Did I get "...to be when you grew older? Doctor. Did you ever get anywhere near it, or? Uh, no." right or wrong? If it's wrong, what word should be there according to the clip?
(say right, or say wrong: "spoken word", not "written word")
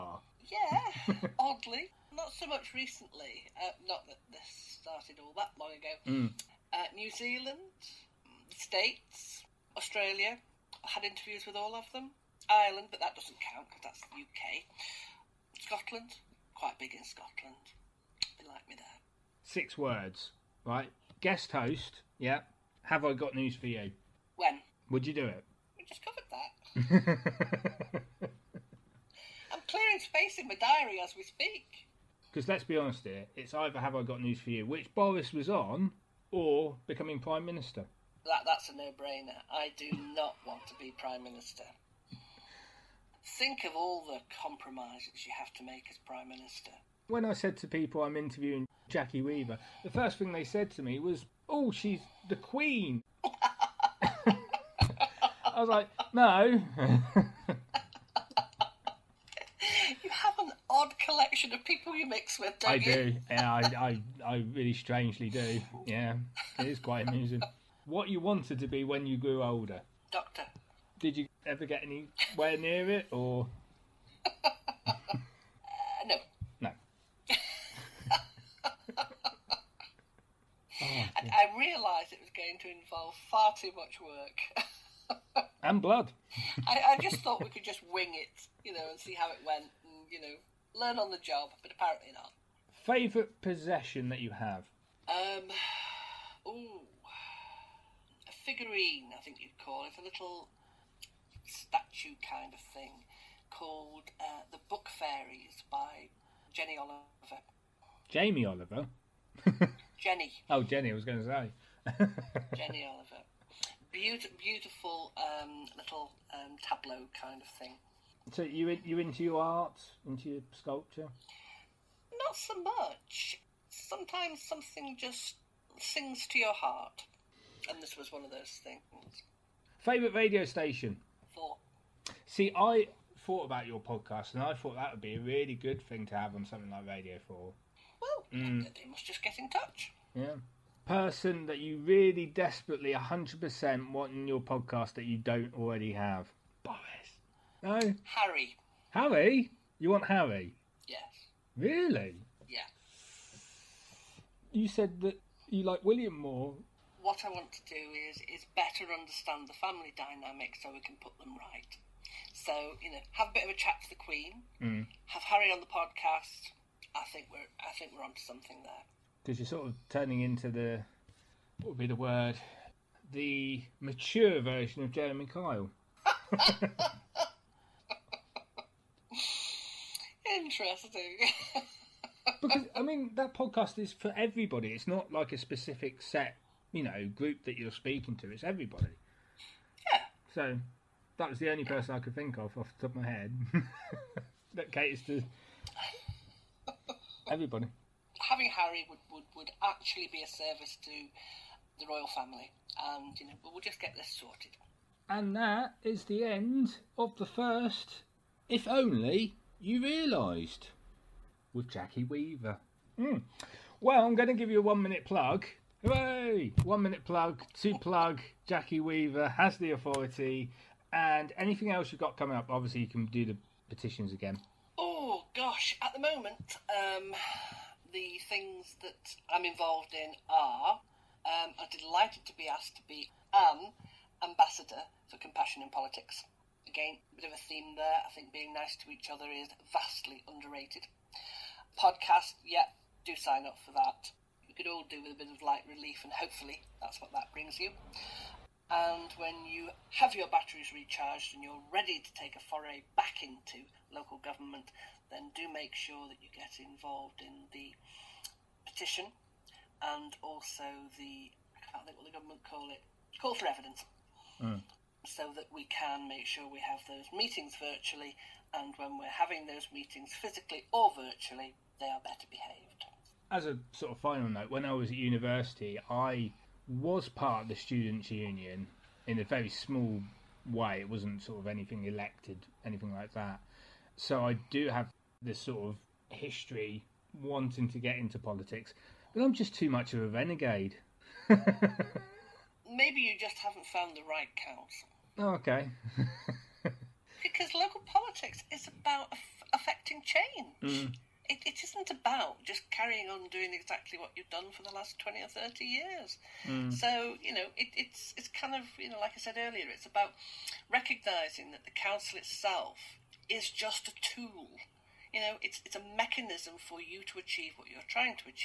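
right.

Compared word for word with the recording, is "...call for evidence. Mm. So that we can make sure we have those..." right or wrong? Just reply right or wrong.
right.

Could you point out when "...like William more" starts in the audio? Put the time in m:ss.
2:35.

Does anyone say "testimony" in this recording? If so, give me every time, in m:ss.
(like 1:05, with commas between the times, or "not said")
not said.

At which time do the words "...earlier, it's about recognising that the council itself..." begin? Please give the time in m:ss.
5:09.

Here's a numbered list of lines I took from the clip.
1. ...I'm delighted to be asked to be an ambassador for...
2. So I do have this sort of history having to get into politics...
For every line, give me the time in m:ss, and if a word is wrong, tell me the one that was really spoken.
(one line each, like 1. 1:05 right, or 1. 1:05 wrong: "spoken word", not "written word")
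1. 3:51 right
2. 4:43 wrong: "wanting", not "having".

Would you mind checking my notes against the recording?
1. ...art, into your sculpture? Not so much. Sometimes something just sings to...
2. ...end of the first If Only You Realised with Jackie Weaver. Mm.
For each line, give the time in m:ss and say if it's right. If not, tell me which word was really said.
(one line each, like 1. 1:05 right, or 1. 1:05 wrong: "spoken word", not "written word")
1. 1:59 right
2. 3:26 right.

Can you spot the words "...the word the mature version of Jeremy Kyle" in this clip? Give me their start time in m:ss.
2:51.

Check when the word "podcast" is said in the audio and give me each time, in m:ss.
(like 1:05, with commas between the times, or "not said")
2:13, 2:24, 2:45, 3:03, 4:01.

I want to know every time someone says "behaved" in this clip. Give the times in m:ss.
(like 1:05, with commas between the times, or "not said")
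4:32.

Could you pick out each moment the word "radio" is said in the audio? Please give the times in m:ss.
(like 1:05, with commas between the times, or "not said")
2:10, 2:16.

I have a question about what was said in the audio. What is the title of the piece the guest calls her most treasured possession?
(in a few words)
The Book Fairies.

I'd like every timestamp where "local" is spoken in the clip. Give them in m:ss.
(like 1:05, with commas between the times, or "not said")
4:13, 4:57.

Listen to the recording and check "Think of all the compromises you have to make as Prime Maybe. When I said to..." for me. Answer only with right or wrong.
wrong.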